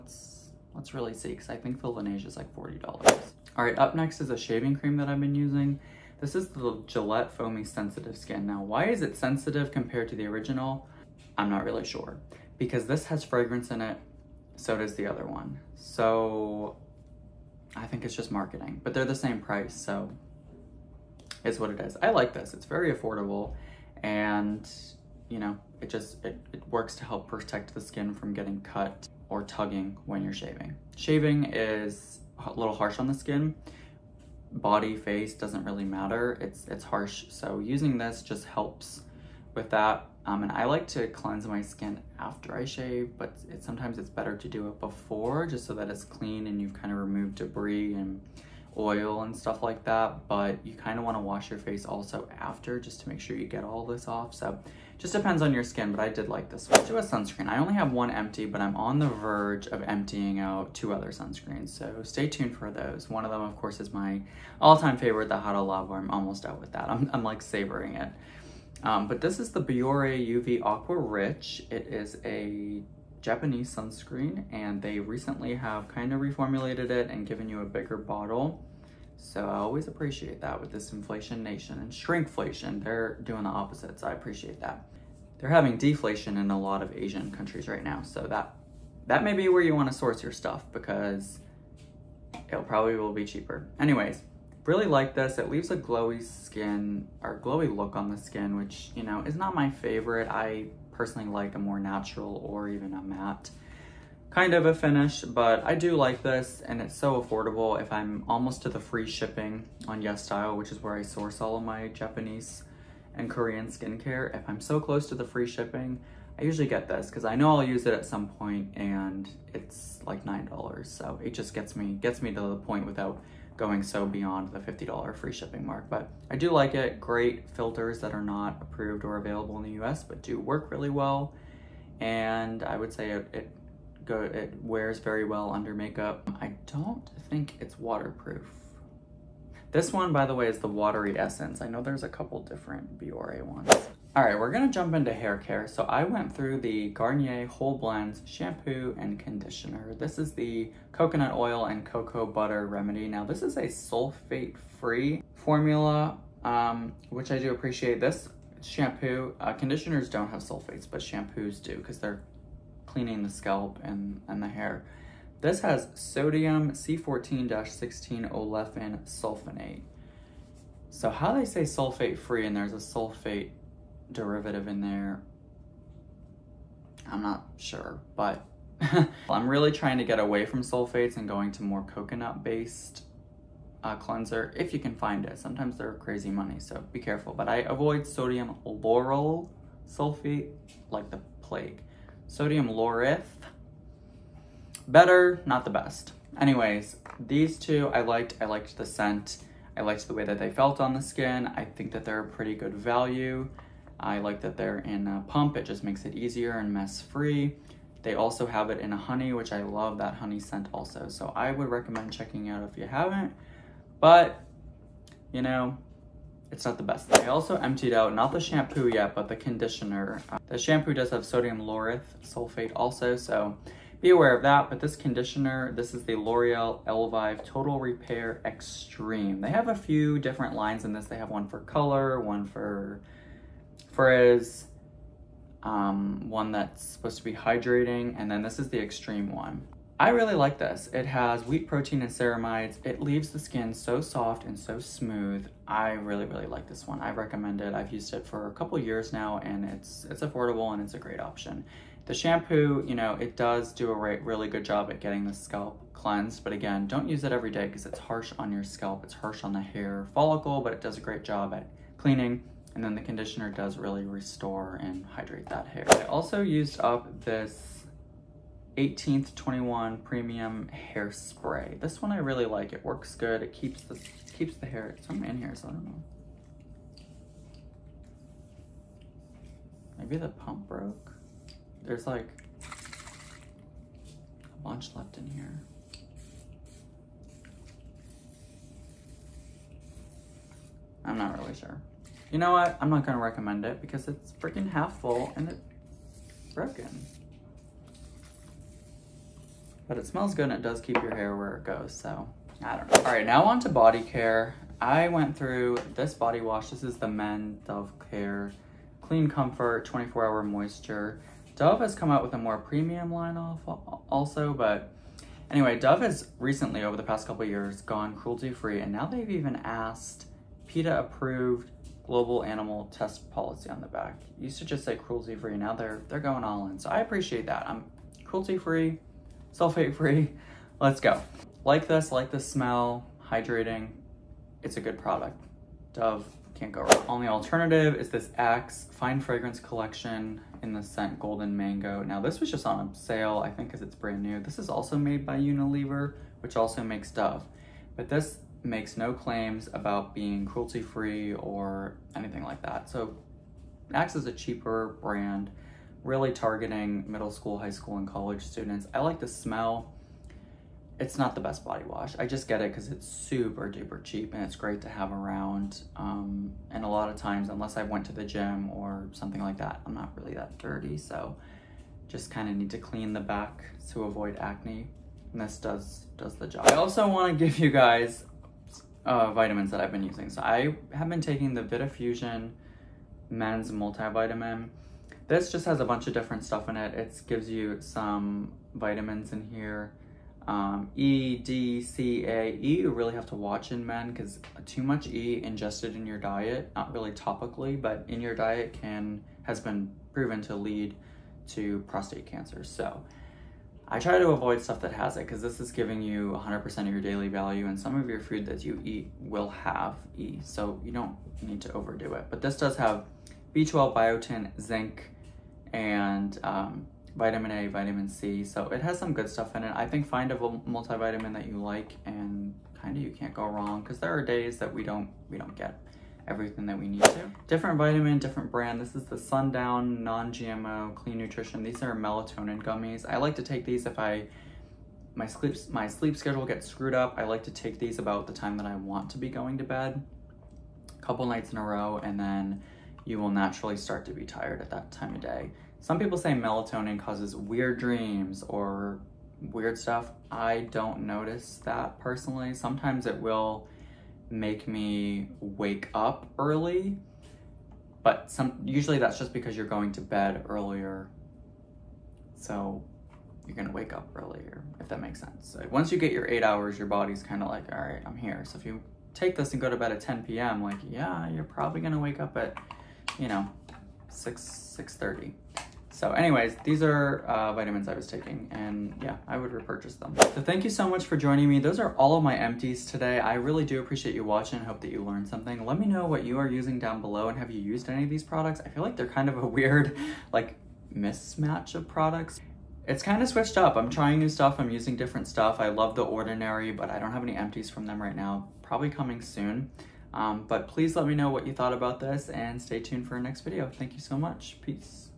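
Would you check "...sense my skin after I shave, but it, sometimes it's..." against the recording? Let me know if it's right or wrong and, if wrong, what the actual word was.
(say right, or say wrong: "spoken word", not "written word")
wrong: "cleanse", not "sense".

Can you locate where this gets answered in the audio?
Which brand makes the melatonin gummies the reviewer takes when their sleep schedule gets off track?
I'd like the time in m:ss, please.
7:09.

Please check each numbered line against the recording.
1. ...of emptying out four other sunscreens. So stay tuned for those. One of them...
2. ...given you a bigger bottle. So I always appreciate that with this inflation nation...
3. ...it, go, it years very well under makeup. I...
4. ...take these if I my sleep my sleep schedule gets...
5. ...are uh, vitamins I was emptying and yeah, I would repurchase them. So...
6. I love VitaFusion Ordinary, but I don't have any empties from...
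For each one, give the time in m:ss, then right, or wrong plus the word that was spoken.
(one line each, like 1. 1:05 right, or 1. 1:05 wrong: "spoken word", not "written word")
1. 0:59 wrong: "two", not "four"
2. 1:17 right
3. 2:13 wrong: "wears", not "years"
4. 7:13 right
5. 7:56 wrong: "taking", not "emptying"
6. 8:15 wrong: "The", not "VitaFusion".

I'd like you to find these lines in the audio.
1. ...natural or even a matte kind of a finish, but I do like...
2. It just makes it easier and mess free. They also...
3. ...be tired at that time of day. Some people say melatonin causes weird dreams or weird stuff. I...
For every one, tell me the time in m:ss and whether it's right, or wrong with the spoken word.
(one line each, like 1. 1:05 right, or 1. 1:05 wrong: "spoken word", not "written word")
1. 1:41 right
2. 3:25 right
3. 7:24 right.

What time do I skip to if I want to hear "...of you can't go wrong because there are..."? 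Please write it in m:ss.
7:02.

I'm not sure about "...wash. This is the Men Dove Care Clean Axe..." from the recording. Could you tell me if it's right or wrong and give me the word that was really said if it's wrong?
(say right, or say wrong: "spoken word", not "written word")
wrong: "Comfort", not "Axe".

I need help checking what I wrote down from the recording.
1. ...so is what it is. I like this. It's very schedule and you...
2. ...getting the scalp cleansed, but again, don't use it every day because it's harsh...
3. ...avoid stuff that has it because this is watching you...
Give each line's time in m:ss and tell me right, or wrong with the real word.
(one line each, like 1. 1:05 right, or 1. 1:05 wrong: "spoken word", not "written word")
1. 0:19 wrong: "affordable", not "schedule"
2. 4:14 right
3. 6:44 wrong: "giving", not "watching".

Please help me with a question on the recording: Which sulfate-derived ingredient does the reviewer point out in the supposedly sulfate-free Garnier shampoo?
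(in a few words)
sodium C14-16 olefin sulfonate.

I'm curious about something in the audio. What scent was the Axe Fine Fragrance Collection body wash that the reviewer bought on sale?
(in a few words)
Golden Mango.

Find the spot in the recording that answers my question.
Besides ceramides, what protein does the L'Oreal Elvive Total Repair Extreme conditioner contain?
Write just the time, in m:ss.
4:01.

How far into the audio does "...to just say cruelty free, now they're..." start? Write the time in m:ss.
5:24.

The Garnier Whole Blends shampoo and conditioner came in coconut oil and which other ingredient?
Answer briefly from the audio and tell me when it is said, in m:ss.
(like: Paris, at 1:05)
cocoa butter, at 2:31.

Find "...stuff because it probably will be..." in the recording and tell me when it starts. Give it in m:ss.
1:30.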